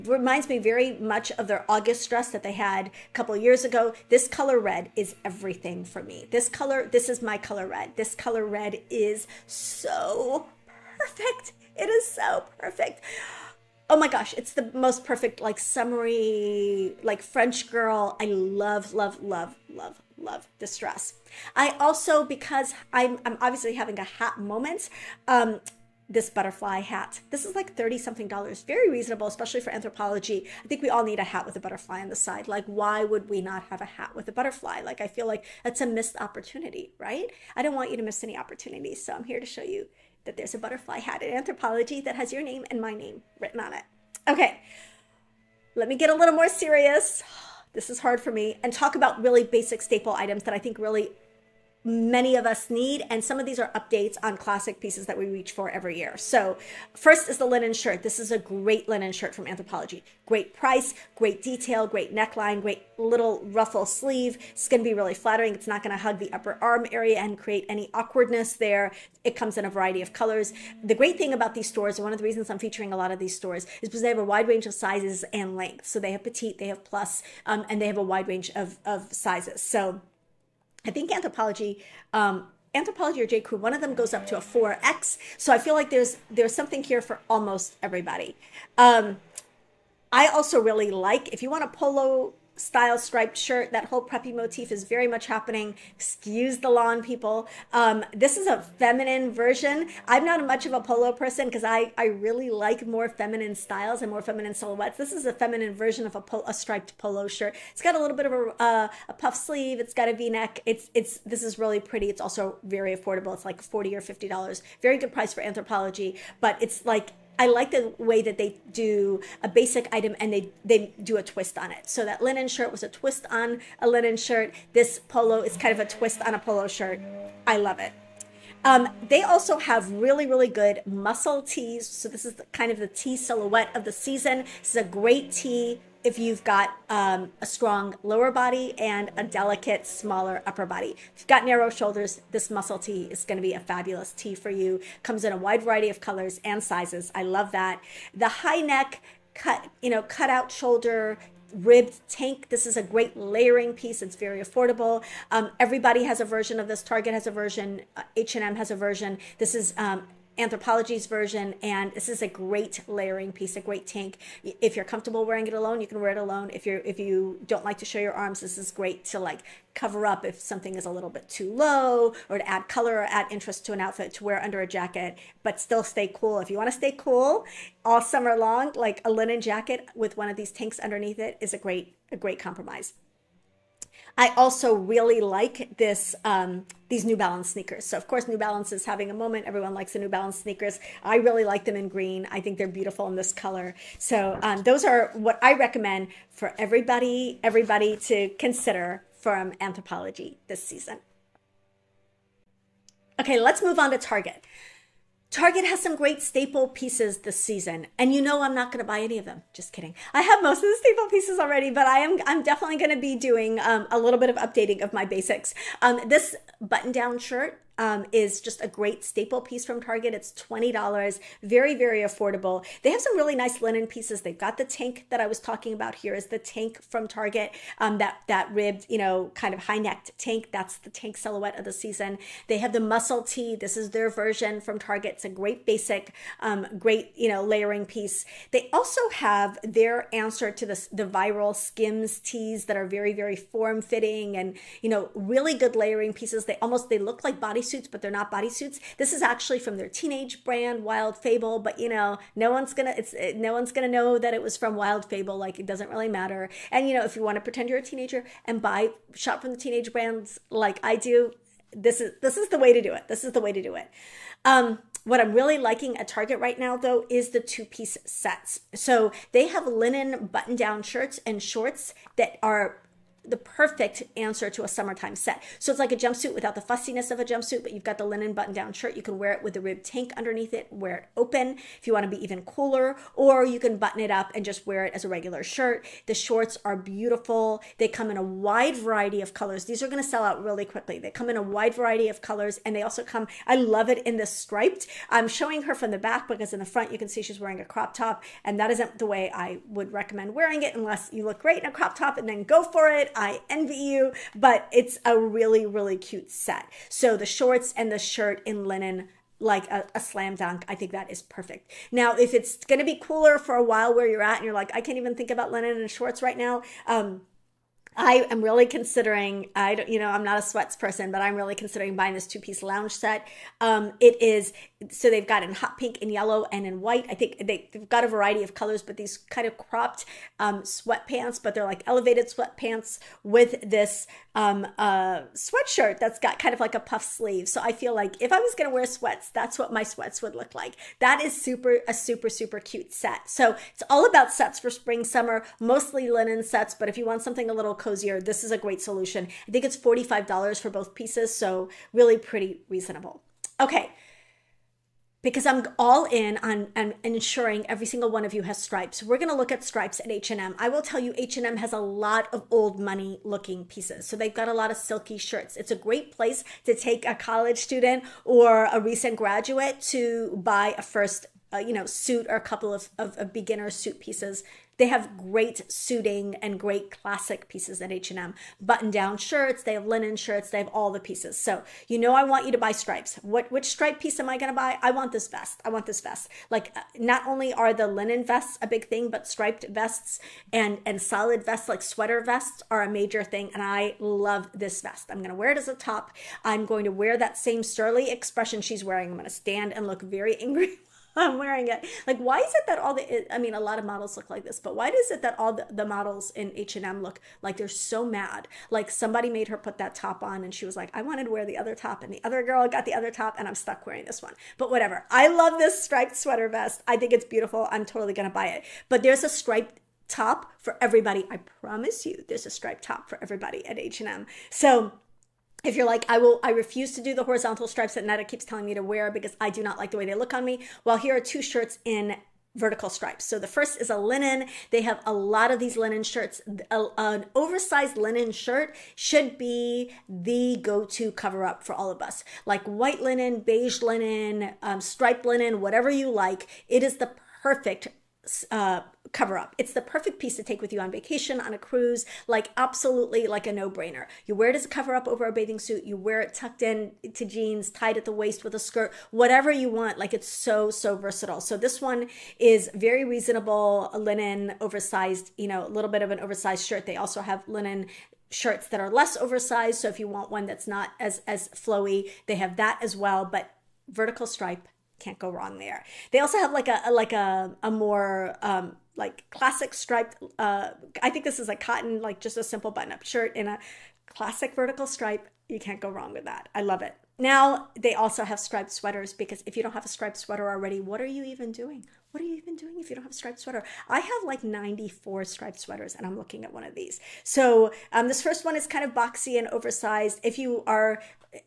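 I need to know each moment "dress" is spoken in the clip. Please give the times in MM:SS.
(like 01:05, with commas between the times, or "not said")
00:02, 00:20.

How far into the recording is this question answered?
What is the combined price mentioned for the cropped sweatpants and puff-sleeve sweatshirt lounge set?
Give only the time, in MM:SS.
05:49.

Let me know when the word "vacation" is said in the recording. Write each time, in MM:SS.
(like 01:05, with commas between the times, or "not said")
07:30.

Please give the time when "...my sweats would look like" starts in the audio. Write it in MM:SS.
05:39.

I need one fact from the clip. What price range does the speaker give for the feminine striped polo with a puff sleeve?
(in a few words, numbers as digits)
40 or $50.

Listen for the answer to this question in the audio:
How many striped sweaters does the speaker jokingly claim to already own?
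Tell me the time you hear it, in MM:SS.
08:14.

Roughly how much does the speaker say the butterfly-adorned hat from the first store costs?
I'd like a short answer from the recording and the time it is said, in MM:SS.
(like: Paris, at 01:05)
30 something dollars, at 00:27.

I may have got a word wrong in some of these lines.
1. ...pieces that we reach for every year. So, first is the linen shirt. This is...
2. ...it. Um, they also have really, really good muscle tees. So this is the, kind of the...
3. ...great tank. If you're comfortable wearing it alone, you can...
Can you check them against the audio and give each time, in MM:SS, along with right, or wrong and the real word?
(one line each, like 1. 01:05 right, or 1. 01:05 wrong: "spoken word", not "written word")
1. 00:54 right
2. 02:07 right
3. 02:43 right.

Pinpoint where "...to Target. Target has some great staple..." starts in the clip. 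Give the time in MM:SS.
03:23.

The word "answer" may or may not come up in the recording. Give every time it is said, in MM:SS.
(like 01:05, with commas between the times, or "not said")
04:00, 04:34.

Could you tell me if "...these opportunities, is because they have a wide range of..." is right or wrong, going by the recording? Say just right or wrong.
wrong.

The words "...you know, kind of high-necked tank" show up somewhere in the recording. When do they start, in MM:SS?
03:48.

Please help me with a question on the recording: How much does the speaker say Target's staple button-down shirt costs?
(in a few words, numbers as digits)
$20.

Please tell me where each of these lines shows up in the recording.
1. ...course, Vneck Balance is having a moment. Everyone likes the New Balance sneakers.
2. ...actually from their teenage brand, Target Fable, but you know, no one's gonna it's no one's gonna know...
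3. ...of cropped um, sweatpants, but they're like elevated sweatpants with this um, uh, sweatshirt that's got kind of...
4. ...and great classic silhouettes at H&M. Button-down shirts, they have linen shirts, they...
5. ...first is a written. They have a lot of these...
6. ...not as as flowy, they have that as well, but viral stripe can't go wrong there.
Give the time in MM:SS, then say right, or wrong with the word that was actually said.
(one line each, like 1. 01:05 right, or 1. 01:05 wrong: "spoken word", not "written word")
1. 03:08 wrong: "New", not "Vneck"
2. 04:09 wrong: "Wild", not "Target"
3. 05:29 right
4. 06:16 wrong: "pieces", not "silhouettes"
5. 07:13 wrong: "linen", not "written"
6. 07:50 wrong: "vertical", not "viral".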